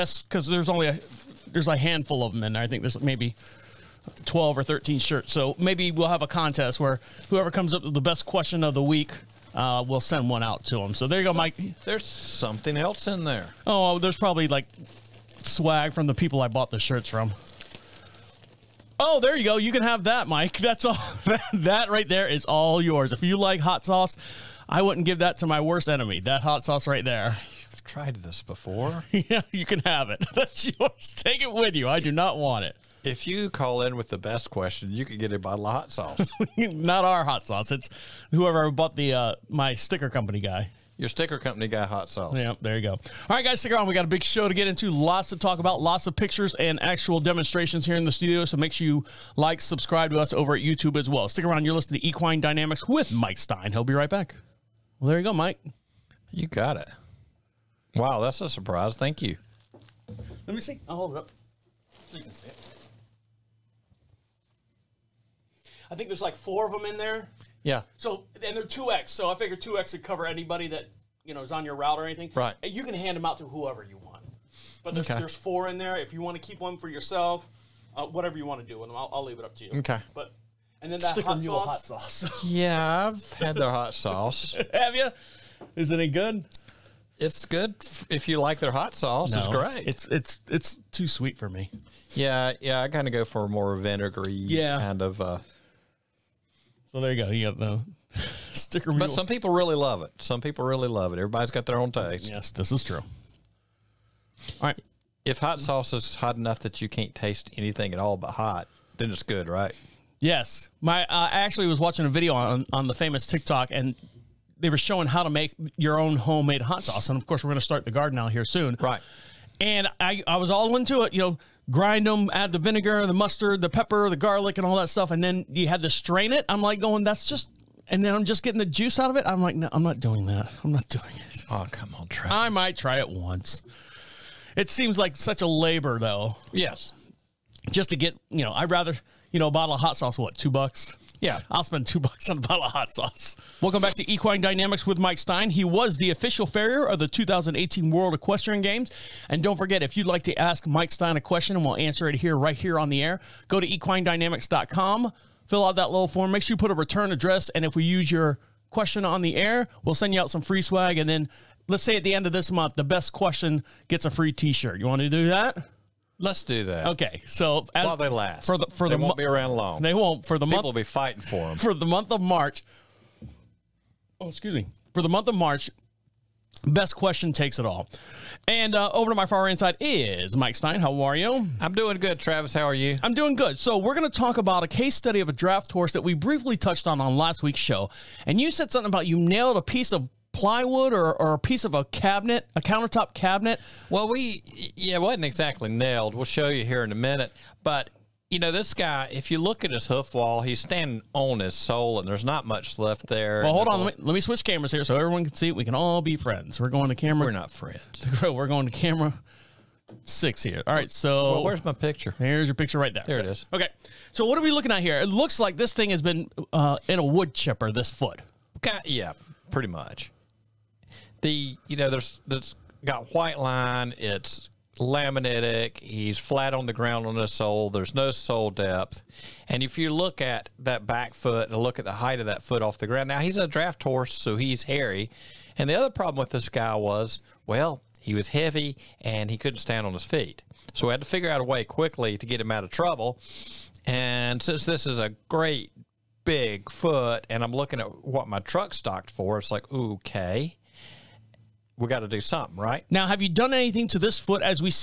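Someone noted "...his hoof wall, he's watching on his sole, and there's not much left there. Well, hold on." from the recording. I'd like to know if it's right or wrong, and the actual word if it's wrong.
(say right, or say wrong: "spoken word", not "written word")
wrong: "standing", not "watching".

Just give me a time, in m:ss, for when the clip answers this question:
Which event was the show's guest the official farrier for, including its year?
2:27.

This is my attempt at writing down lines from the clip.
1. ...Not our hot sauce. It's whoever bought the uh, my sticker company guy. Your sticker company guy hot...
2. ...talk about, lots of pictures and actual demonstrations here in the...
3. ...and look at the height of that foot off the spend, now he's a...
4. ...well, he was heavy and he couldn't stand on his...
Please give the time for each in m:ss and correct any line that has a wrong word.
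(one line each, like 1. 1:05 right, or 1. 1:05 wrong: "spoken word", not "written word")
1. 0:36 right
2. 0:45 right
3. 3:51 wrong: "ground", not "spend"
4. 3:57 right.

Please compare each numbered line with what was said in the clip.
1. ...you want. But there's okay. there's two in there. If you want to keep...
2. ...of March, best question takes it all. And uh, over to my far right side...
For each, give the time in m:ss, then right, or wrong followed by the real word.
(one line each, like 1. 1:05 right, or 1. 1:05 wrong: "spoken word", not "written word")
1. 1:13 wrong: "four", not "two"
2. 2:55 right.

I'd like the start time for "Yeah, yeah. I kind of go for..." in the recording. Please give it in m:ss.
1:32.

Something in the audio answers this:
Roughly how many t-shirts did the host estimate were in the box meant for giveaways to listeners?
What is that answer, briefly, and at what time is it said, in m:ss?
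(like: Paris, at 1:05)
12 or 13, at 0:04.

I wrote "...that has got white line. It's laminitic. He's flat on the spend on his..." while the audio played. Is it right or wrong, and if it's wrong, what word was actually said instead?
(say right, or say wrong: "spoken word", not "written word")
wrong: "ground", not "spend".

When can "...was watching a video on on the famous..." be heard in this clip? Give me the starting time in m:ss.
1:51.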